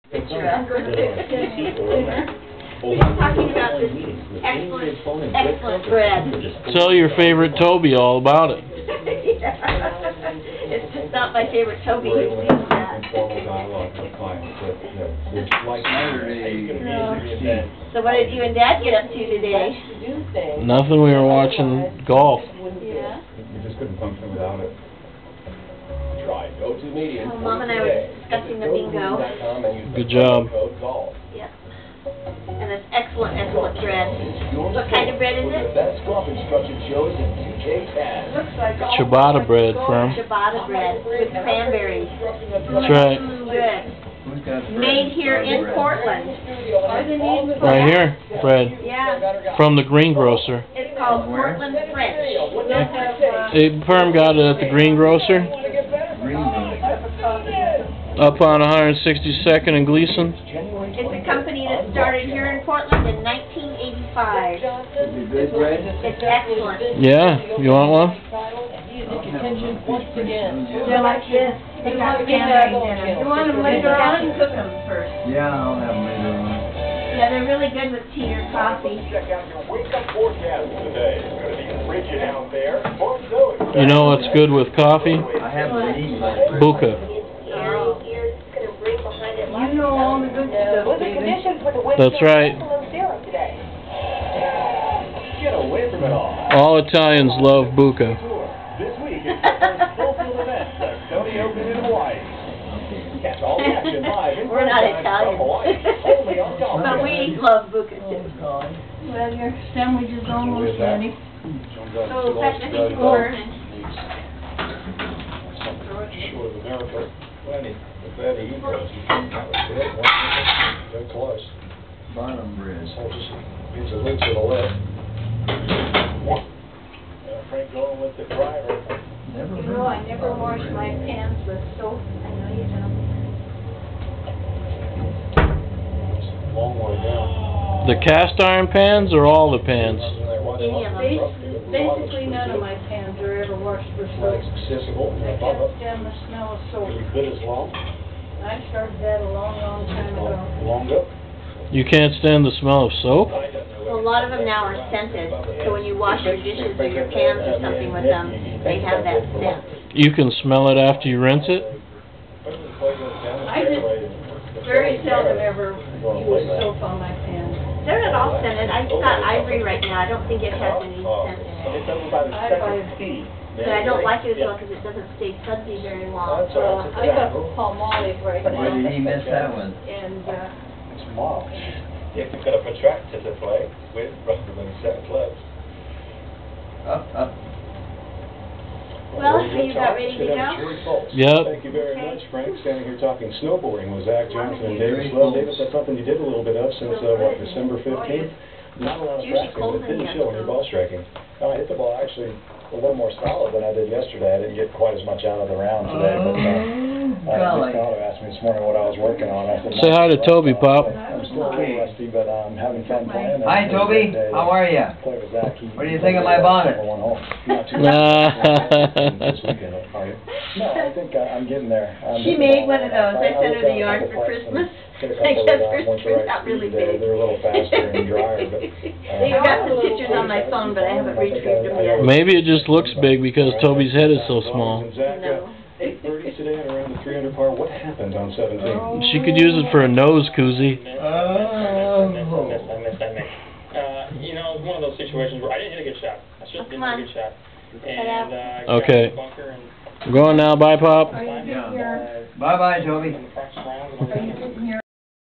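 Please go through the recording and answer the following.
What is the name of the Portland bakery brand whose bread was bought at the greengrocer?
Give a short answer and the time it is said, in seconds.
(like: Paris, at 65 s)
Portland Fresh, at 51 s.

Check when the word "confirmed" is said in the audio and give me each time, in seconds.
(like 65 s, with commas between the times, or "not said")
not said.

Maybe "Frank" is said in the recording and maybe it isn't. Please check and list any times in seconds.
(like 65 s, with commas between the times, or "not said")
127 s, 192 s.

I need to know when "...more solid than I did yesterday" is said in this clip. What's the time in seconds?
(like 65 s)
202 s.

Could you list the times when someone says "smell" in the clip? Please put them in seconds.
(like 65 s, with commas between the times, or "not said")
146 s, 152 s, 160 s.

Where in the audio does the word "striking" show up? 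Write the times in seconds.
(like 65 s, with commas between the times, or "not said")
200 s.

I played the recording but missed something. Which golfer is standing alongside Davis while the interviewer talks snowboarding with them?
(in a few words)
Zach Johnson.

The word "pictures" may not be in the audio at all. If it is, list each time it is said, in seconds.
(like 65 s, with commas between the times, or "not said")
229 s.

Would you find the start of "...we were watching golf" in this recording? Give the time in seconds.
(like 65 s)
21 s.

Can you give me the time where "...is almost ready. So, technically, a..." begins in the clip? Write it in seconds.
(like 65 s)
110 s.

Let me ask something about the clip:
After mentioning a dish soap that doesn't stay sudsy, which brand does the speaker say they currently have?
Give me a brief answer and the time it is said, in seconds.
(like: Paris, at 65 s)
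Palmolive, at 177 s.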